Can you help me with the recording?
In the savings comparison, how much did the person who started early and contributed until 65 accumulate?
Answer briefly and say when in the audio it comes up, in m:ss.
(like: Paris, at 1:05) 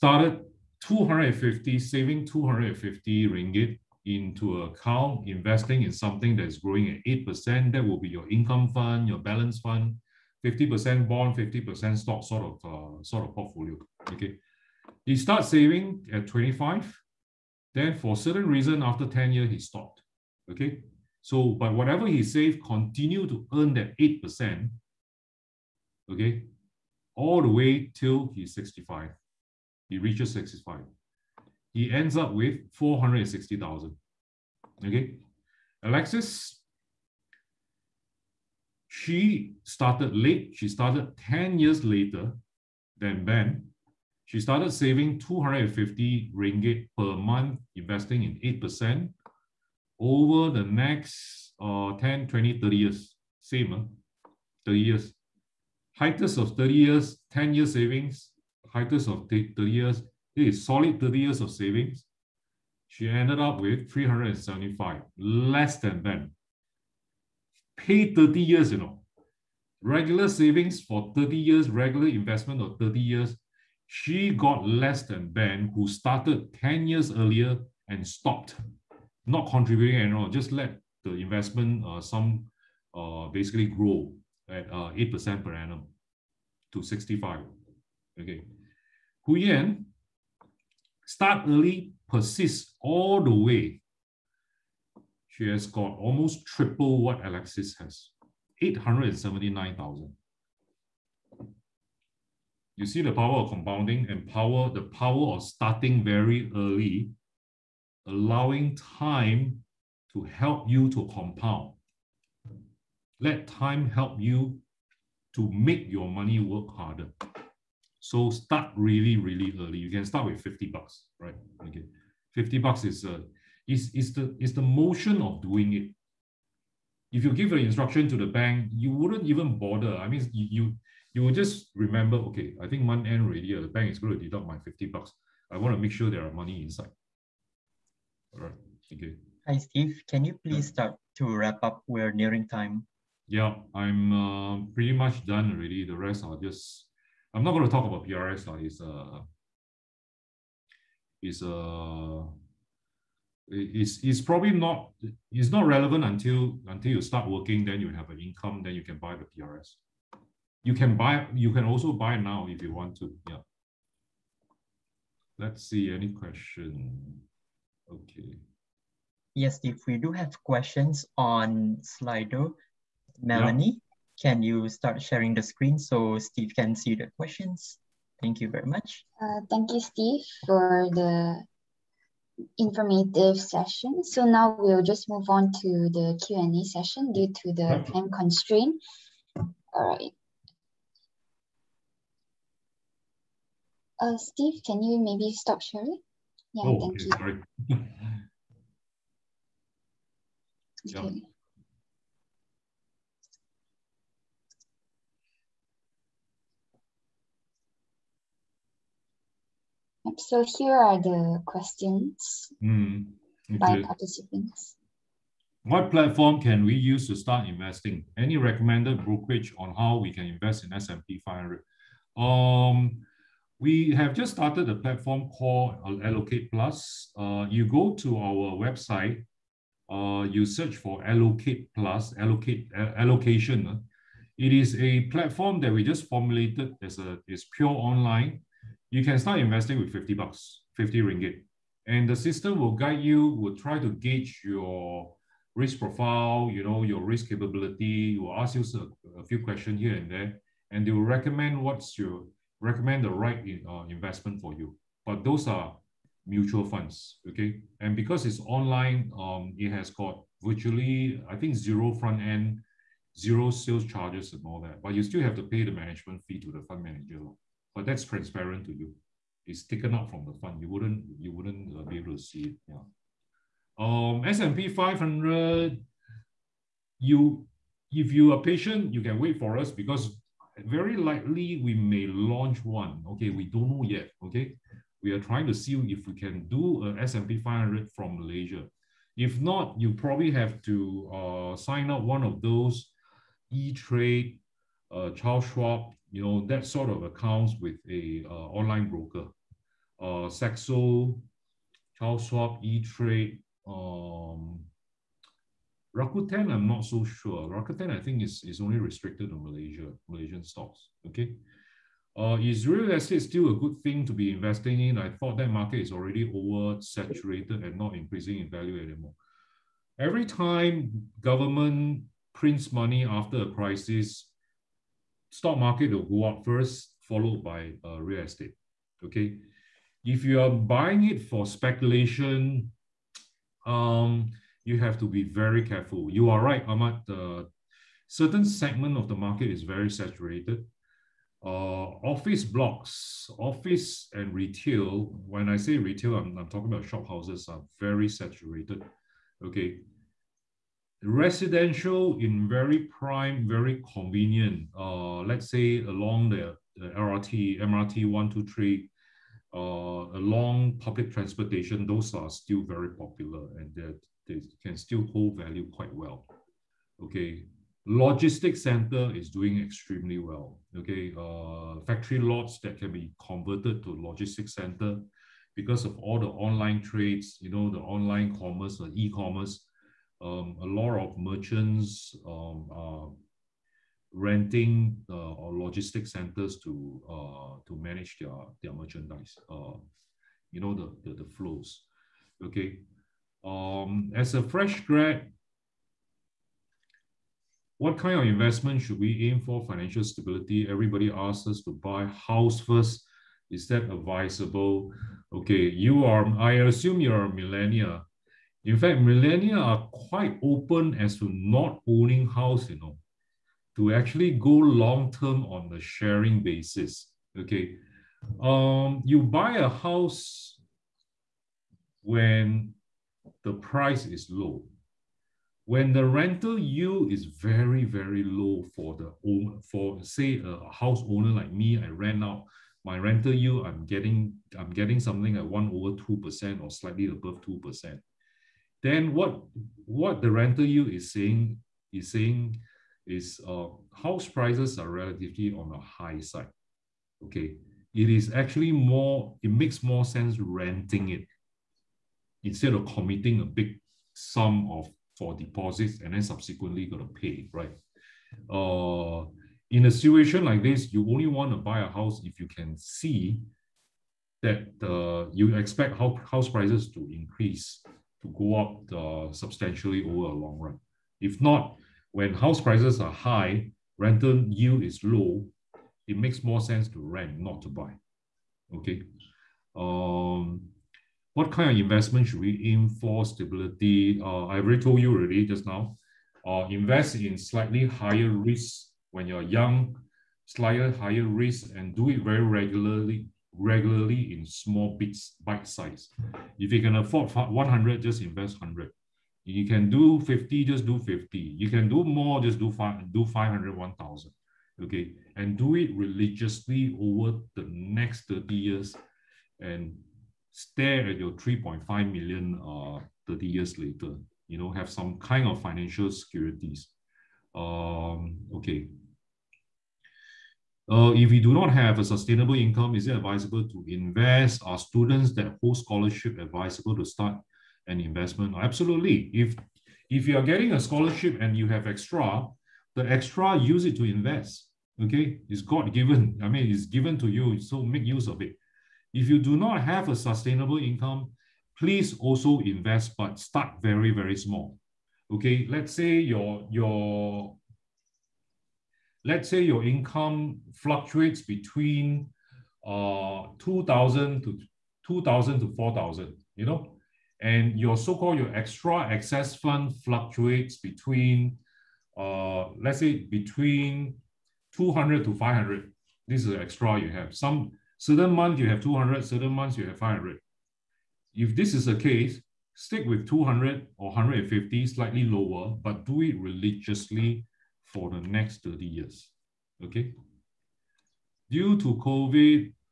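879,000, at 1:38.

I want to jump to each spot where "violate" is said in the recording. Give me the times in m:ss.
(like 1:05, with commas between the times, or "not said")
not said.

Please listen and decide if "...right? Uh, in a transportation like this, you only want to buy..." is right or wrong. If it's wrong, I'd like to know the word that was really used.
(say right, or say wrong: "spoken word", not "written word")
wrong: "situation", not "transportation".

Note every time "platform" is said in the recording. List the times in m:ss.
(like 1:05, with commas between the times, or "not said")
3:35, 3:44, 3:55.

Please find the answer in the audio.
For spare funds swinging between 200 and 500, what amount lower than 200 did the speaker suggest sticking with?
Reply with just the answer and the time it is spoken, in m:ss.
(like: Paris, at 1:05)
150, at 9:34.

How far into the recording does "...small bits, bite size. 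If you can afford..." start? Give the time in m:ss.
8:14.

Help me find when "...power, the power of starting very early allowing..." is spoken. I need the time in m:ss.
1:44.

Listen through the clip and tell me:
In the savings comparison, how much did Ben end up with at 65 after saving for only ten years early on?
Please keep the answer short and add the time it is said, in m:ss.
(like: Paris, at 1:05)
460,000, at 0:32.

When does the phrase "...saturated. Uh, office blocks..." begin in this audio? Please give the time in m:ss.
5:39.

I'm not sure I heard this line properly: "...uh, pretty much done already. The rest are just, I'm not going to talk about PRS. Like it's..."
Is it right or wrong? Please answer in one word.
right.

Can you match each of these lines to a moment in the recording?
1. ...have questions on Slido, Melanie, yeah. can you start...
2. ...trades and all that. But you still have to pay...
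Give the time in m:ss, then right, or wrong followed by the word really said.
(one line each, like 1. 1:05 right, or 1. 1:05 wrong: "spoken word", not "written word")
1. 2:50 right
2. 4:23 wrong: "charges", not "trades".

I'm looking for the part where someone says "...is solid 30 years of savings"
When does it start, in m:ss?
1:00.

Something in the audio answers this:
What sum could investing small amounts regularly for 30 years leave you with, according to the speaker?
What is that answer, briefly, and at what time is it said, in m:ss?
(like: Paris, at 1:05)
3.5 million, at 8:31.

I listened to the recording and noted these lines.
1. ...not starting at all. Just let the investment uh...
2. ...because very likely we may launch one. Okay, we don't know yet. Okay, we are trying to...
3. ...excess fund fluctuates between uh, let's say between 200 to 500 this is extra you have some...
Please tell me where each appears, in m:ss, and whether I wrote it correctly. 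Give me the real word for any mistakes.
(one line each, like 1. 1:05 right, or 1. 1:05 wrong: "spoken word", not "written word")
1. 1:19 wrong: "contributing", not "starting"
2. 4:39 right
3. 9:19 right.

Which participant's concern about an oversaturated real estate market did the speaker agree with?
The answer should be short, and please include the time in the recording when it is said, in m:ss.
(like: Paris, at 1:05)
Ahmad, at 5:36.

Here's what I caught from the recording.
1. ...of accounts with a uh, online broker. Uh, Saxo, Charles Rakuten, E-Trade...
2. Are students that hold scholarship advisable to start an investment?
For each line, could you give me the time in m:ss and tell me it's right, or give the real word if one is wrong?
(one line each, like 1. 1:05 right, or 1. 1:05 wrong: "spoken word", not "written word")
1. 4:56 wrong: "Schwab", not "Rakuten"
2. 8:44 right.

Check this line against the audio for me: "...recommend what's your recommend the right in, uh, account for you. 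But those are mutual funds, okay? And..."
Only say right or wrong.
wrong.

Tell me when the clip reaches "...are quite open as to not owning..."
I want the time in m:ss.
6:49.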